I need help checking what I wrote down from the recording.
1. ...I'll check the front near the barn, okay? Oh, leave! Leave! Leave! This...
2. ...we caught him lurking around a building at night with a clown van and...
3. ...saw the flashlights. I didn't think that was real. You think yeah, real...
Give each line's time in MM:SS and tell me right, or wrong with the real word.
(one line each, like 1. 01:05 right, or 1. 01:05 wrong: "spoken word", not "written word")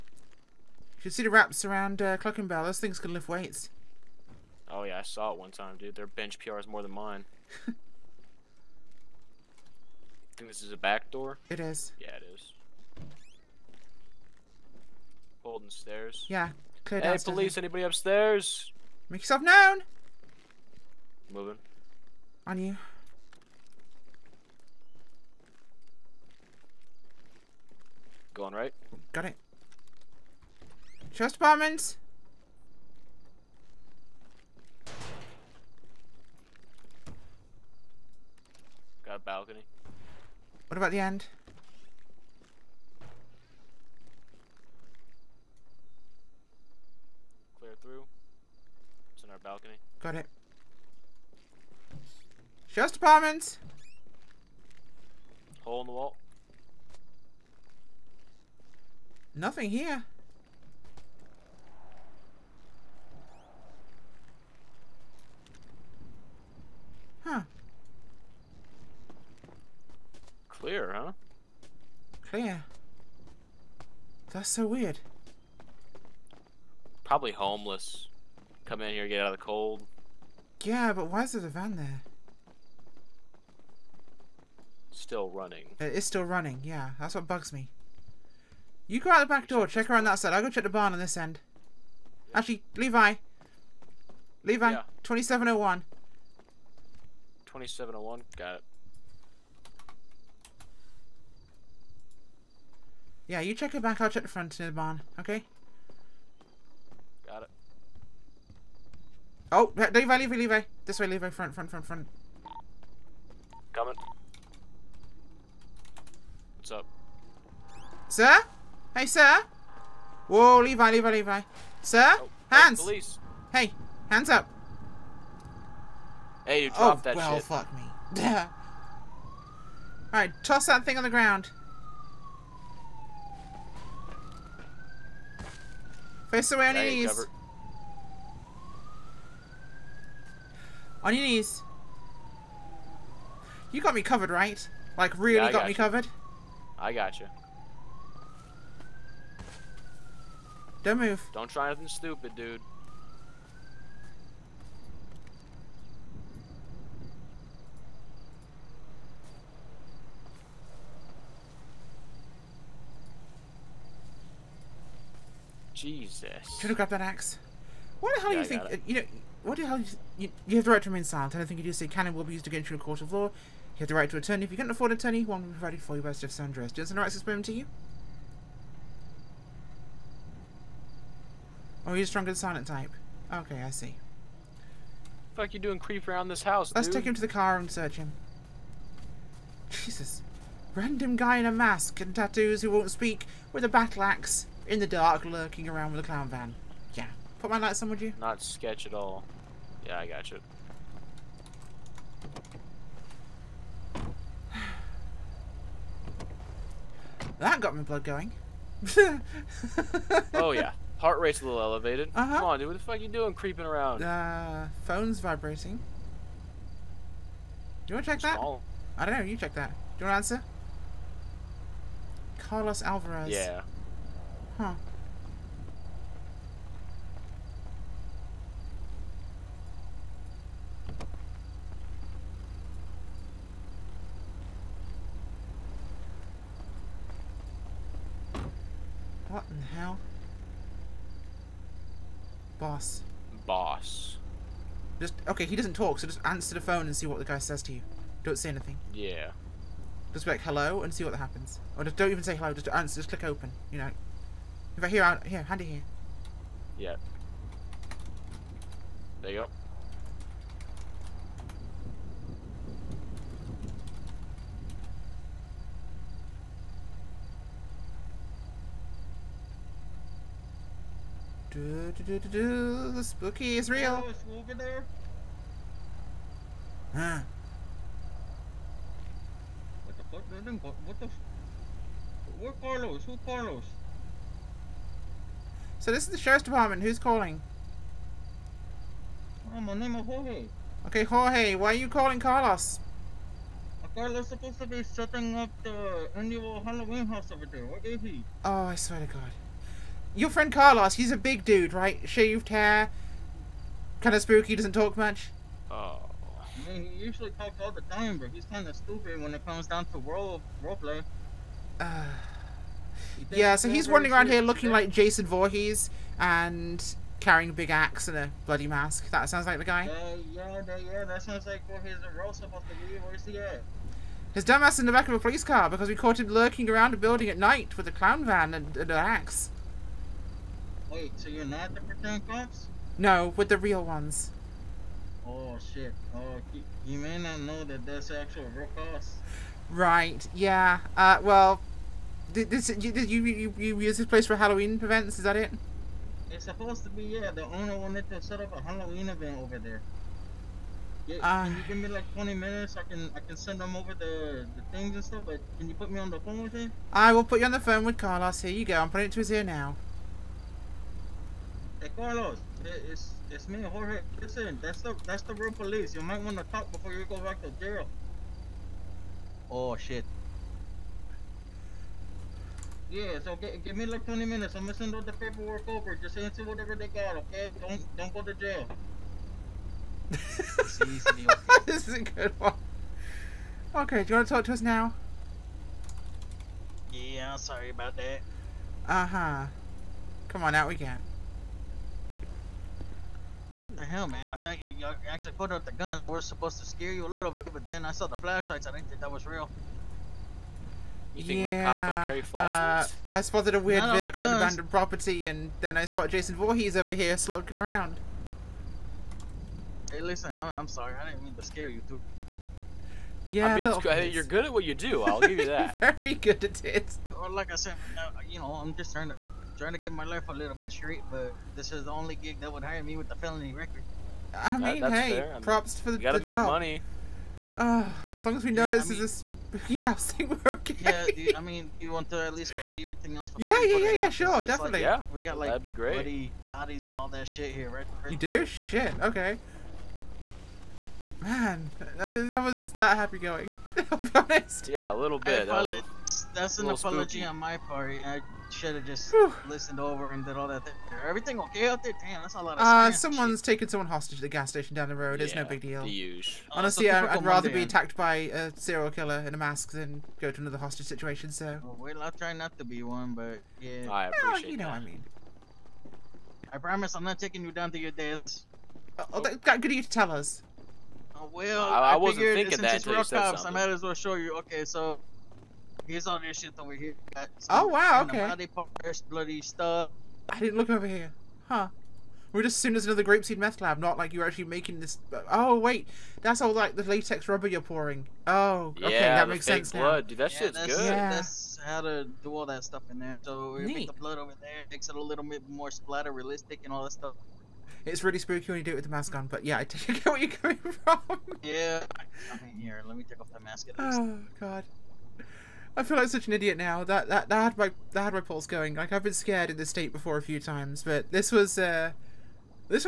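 1. 01:43 right
2. 05:25 right
3. 06:37 right.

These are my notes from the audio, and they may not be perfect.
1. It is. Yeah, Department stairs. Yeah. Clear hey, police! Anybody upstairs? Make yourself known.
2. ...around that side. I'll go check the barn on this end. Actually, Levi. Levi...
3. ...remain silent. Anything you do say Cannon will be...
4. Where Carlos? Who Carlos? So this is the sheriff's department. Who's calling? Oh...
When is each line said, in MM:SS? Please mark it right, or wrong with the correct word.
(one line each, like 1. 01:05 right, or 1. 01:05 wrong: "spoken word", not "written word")
1. 00:11 wrong: "Golden", not "Department"
2. 01:29 right
3. 02:50 right
4. 04:42 right.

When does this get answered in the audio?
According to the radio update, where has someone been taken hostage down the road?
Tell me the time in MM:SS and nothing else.
07:34.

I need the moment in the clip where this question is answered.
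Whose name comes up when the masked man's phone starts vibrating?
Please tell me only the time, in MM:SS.
03:42.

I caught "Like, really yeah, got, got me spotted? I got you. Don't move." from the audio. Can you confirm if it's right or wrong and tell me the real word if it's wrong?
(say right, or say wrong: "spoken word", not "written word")
wrong: "covered", not "spotted".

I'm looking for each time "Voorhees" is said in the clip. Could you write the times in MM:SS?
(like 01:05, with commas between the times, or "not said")
05:15, 05:21, 06:46.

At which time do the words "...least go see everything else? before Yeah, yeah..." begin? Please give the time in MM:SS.
07:12.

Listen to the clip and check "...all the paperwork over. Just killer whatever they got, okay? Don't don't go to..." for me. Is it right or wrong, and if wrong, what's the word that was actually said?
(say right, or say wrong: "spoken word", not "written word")
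wrong: "answer", not "killer".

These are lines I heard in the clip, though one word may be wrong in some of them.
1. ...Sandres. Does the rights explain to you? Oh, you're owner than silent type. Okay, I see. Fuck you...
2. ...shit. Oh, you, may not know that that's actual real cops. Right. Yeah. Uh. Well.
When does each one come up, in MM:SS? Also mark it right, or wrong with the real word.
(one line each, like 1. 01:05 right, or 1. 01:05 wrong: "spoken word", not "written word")
1. 02:56 wrong: "stronger", not "owner"
2. 05:35 right.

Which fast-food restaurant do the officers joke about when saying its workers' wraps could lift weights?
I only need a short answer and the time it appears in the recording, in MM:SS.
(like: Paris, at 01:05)
Cluckin' Bell, at 00:02.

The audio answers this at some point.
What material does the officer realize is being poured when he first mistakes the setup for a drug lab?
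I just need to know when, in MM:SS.
08:06.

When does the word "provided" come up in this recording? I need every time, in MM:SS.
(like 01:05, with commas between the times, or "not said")
02:55.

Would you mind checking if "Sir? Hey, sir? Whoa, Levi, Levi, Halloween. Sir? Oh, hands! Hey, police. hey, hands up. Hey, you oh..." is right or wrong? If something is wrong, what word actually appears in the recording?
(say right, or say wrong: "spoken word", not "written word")
wrong: "Levi", not "Halloween".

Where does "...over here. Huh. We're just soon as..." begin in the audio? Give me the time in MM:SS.
08:00.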